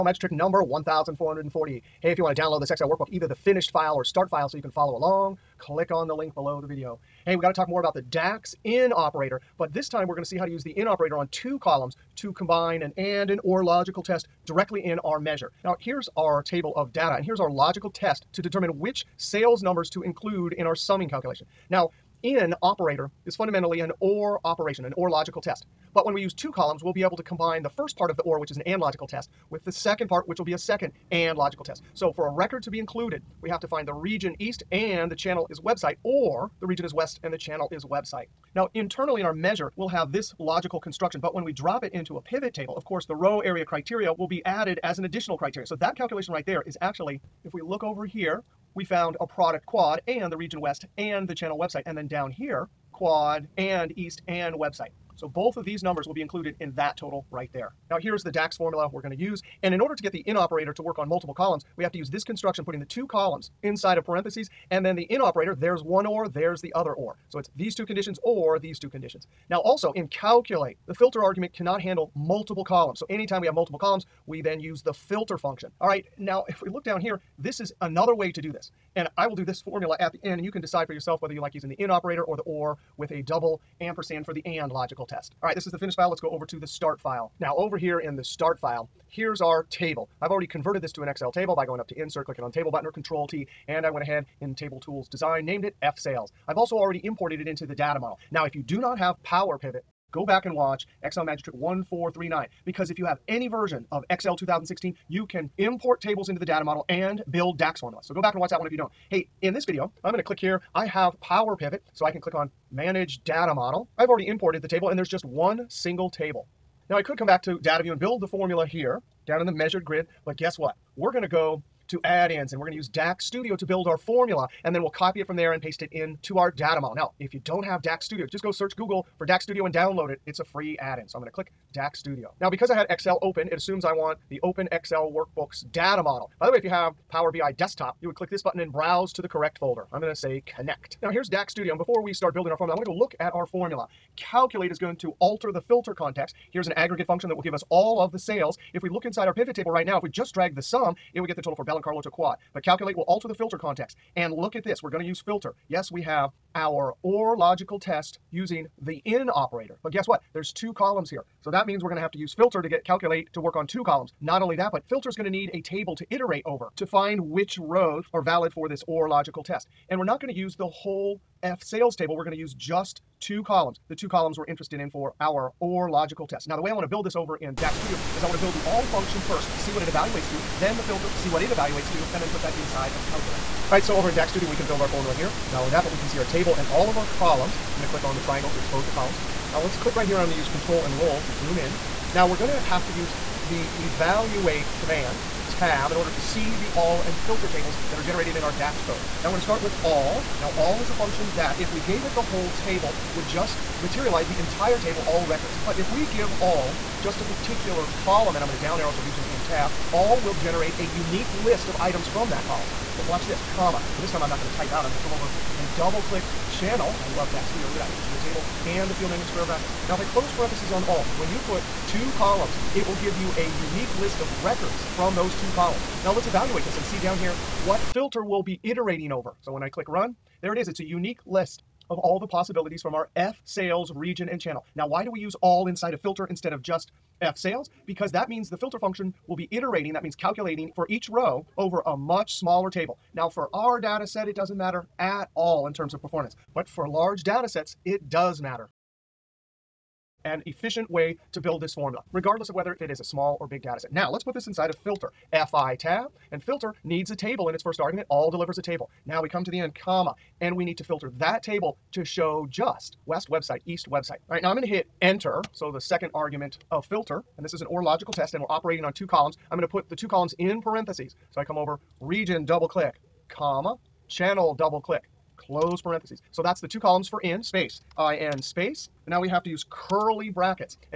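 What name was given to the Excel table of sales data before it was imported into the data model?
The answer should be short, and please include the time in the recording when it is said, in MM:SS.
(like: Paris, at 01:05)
F-Sales, at 01:35.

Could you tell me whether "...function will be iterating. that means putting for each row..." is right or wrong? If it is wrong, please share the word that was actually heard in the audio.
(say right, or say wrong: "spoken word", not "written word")
wrong: "calculating", not "putting".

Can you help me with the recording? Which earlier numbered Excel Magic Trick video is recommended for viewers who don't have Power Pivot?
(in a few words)
1439.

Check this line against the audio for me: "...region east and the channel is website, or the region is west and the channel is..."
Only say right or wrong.
right.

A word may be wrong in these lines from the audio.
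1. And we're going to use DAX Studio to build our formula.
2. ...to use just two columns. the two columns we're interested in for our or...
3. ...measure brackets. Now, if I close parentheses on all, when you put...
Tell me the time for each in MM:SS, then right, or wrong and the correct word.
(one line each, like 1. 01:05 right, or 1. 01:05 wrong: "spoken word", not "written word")
1. 02:02 right
2. 02:52 right
3. 03:39 wrong: "square", not "measure".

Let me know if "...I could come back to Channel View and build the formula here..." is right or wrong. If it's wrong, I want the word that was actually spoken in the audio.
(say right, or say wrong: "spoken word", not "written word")
wrong: "Data", not "Channel".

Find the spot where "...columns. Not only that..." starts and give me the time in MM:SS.
02:43.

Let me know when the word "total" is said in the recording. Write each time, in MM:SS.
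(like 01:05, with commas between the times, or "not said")
00:56, 02:31.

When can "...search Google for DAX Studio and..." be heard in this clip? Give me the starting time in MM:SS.
02:08.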